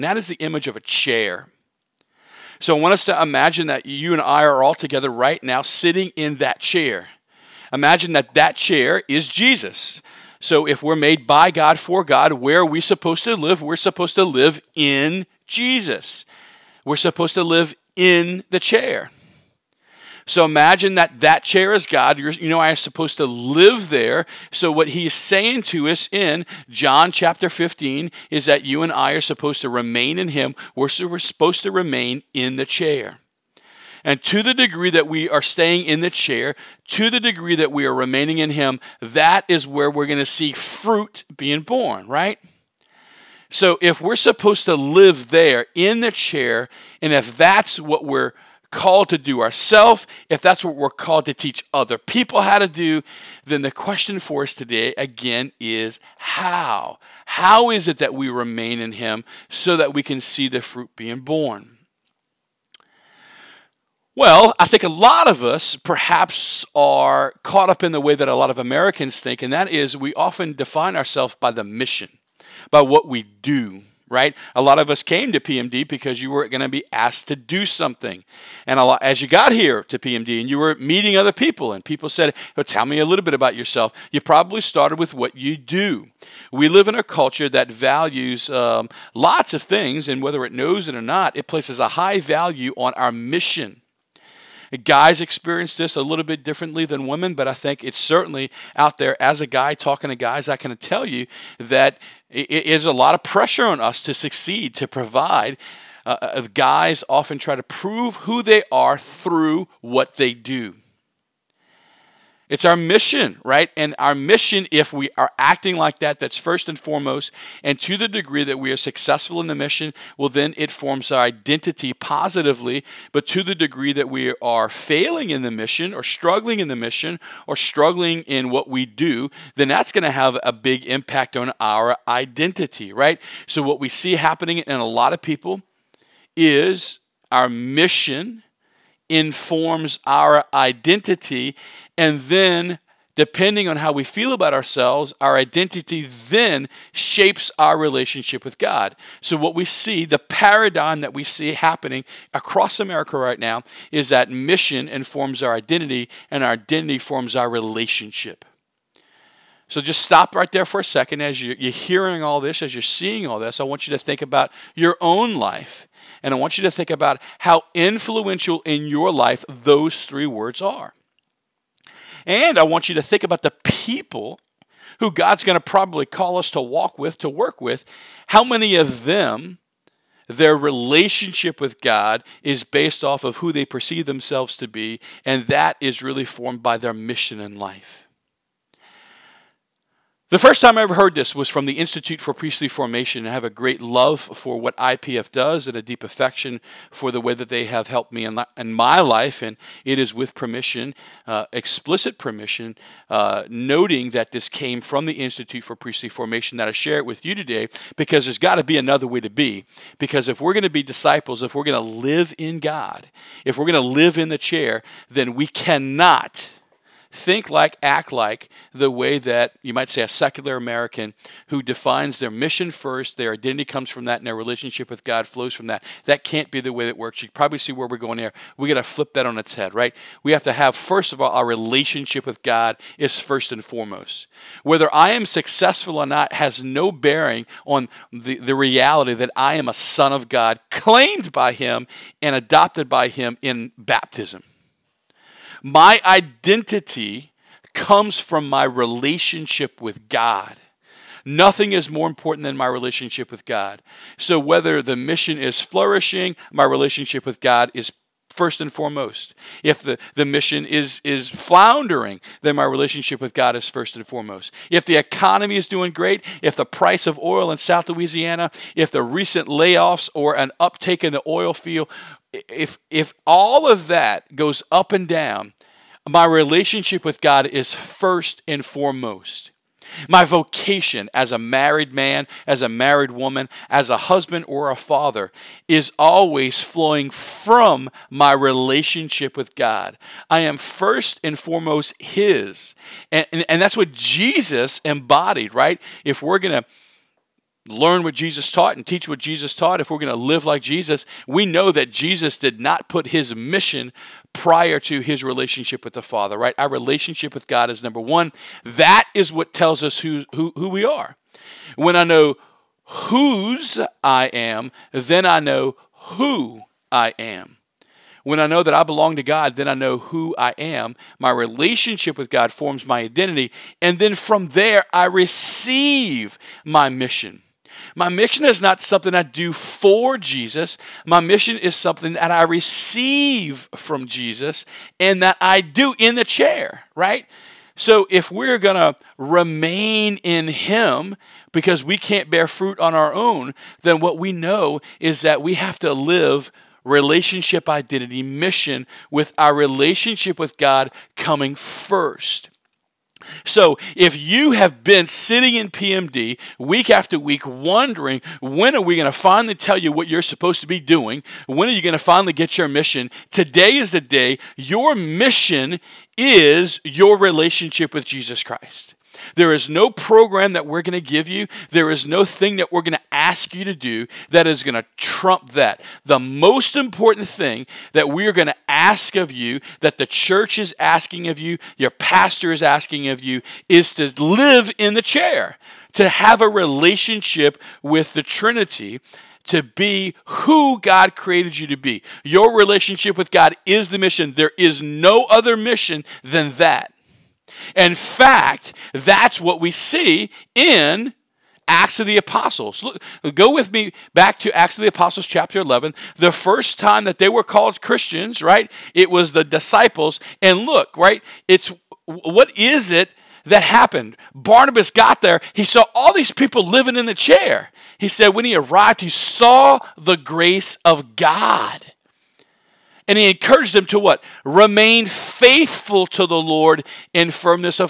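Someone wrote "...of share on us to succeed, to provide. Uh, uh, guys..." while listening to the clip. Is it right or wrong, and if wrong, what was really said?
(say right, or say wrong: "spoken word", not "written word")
wrong: "pressure", not "share".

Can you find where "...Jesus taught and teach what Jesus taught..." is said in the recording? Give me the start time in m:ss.
4:58.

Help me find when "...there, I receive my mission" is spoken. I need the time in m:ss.
5:24.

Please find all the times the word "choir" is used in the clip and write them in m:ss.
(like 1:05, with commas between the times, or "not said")
not said.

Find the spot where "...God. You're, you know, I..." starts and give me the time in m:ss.
0:21.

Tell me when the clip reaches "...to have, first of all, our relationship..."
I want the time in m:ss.
3:50.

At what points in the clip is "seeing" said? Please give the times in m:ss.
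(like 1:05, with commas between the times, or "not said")
2:42.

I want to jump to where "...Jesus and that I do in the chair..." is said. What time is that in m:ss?
5:34.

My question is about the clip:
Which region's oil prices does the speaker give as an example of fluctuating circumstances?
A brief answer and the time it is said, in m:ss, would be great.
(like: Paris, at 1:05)
South Louisiana, at 4:27.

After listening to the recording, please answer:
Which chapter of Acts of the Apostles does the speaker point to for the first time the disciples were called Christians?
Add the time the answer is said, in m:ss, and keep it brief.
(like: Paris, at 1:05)
Chapter 11, at 6:45.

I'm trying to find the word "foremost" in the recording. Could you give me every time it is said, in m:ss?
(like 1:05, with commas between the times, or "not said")
1:56, 3:53, 4:18, 4:24, 4:38, 4:51.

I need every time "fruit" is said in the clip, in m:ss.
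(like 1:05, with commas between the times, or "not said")
0:40, 1:00, 5:42.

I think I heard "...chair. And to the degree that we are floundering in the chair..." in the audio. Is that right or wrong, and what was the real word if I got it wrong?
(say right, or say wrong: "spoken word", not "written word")
wrong: "staying", not "floundering".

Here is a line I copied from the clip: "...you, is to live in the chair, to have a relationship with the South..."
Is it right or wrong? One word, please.
wrong.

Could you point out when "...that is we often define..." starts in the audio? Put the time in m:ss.
1:09.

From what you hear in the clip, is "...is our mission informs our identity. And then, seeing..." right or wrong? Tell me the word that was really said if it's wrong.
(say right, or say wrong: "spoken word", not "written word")
wrong: "depending", not "seeing".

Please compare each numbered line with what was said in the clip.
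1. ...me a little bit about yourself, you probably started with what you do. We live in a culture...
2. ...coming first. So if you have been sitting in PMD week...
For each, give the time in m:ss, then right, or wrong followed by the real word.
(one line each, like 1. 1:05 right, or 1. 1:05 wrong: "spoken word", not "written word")
1. 1:22 right
2. 5:51 right.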